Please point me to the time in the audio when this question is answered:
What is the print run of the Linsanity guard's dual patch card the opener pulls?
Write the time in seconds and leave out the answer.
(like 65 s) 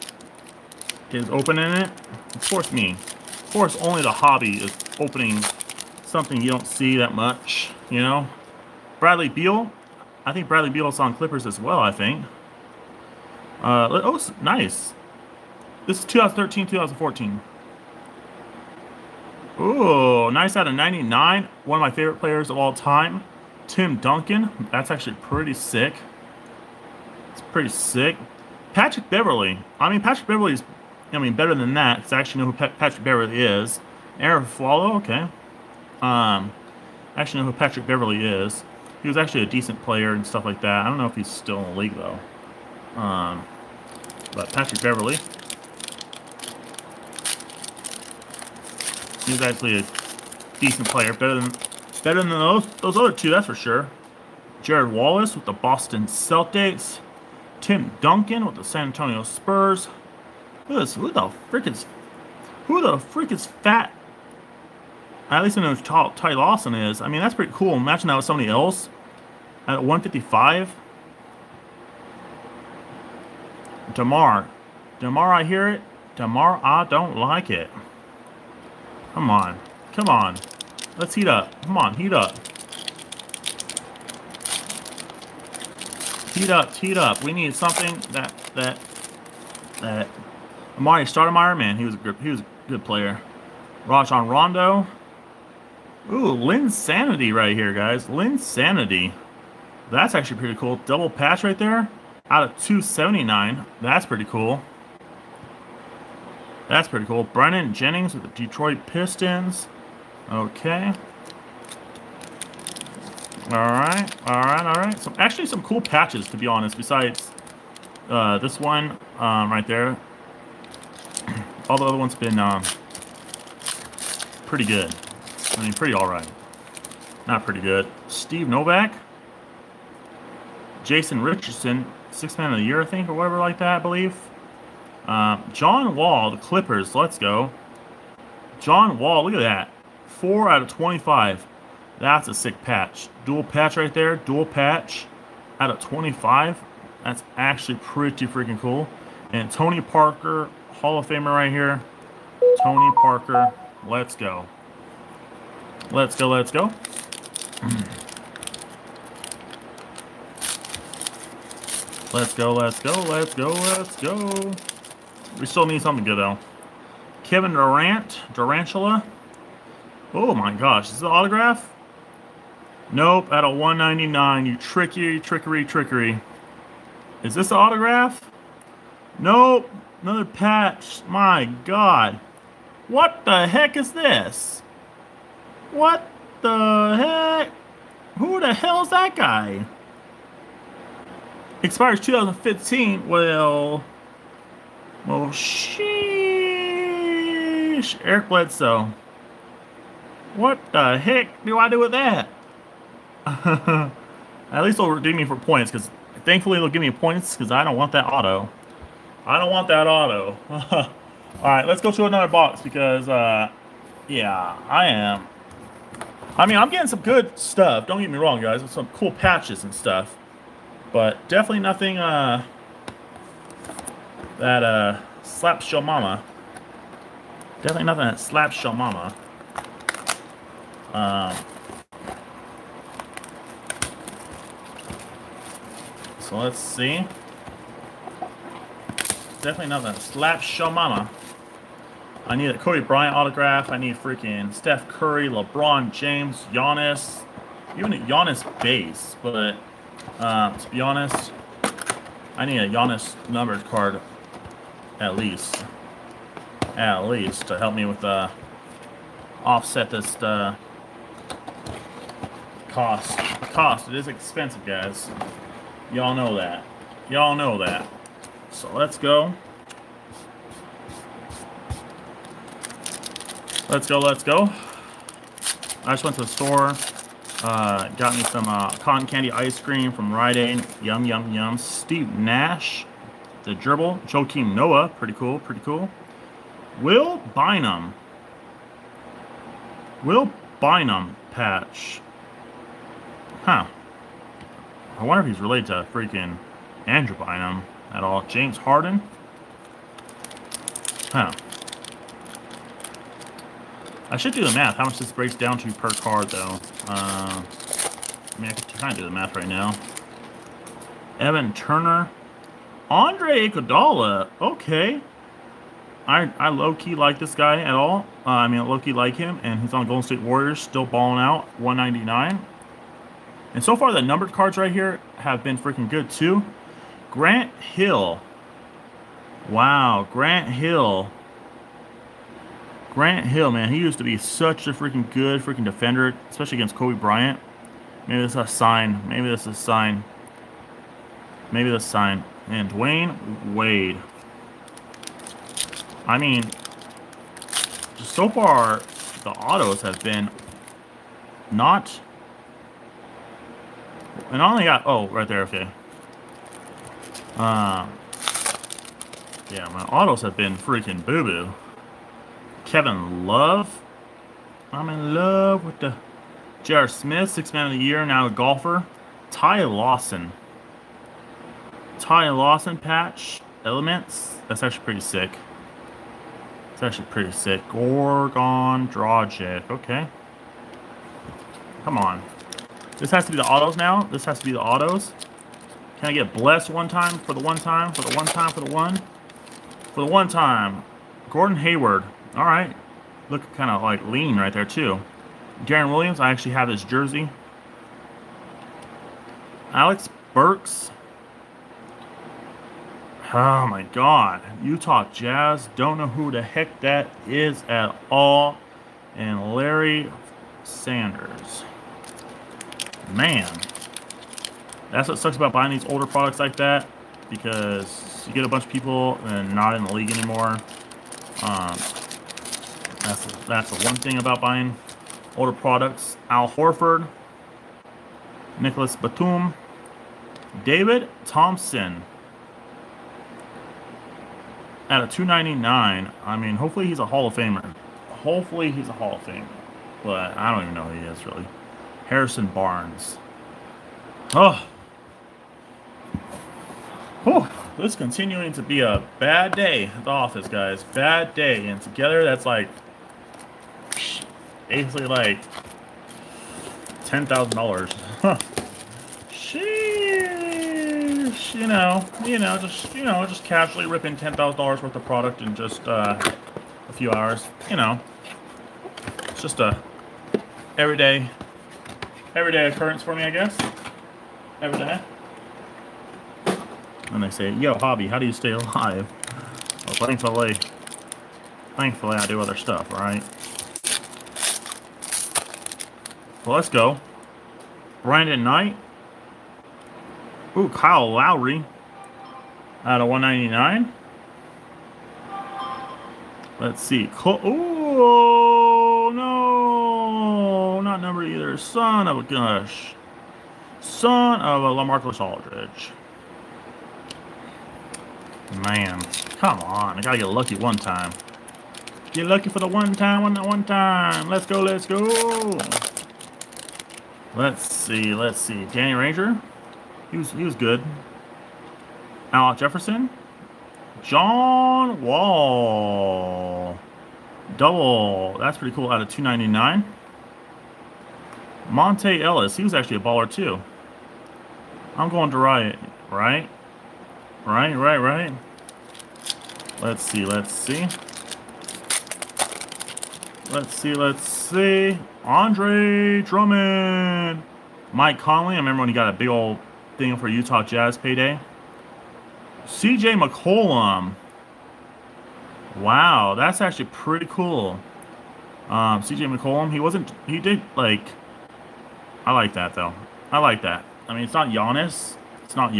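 102 s.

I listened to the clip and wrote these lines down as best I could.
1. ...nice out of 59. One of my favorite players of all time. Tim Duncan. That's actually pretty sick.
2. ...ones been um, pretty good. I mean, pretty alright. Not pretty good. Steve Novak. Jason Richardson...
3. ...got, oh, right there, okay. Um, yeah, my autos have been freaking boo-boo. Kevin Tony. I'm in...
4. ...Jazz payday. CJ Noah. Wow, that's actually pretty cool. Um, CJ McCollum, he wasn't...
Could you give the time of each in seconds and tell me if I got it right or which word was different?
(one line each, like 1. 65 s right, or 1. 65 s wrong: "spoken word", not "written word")
1. 20 s wrong: "99", not "59"
2. 121 s right
3. 354 s wrong: "Love", not "Tony"
4. 550 s wrong: "McCollum", not "Noah".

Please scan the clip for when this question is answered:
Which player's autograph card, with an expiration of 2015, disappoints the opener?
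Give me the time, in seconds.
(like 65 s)
198 s.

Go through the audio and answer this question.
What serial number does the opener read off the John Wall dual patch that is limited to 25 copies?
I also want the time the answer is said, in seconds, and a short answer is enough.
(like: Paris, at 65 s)
4, at 140 s.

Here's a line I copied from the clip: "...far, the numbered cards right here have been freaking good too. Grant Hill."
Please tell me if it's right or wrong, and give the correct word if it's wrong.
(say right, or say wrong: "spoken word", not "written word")
right.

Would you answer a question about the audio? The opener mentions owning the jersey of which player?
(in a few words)
Deron Williams.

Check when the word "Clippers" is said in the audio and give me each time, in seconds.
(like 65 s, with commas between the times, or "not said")
11 s, 136 s.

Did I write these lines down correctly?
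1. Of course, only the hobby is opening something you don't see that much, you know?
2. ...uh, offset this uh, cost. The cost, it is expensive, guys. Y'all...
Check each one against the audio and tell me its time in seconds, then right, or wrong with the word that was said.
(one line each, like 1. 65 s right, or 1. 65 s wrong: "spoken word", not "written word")
1. 2 s right
2. 258 s right.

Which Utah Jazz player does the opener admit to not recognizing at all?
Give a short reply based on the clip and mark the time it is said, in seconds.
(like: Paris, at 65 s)
Alec Burks, at 399 s.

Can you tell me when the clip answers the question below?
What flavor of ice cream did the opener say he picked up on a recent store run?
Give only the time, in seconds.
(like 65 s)
278 s.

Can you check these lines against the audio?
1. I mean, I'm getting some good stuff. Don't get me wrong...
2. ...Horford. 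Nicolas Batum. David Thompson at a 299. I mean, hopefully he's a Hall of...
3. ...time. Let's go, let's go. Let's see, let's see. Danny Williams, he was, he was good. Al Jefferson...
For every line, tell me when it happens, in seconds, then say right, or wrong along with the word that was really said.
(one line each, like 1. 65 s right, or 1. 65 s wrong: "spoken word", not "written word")
1. 216 s right
2. 426 s right
3. 513 s wrong: "Granger", not "Williams".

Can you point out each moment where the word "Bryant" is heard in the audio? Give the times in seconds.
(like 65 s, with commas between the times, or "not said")
242 s, 336 s.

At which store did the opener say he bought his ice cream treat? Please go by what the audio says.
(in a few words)
Rite Aid.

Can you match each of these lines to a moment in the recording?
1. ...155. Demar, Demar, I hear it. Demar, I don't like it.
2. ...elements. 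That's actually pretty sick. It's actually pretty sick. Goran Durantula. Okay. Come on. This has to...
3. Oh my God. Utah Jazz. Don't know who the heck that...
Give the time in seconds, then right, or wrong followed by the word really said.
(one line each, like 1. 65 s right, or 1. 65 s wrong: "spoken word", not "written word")
1. 69 s right
2. 373 s wrong: "Dragic", not "Durantula"
3. 403 s right.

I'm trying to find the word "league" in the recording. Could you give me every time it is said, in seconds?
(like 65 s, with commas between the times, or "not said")
41 s, 419 s.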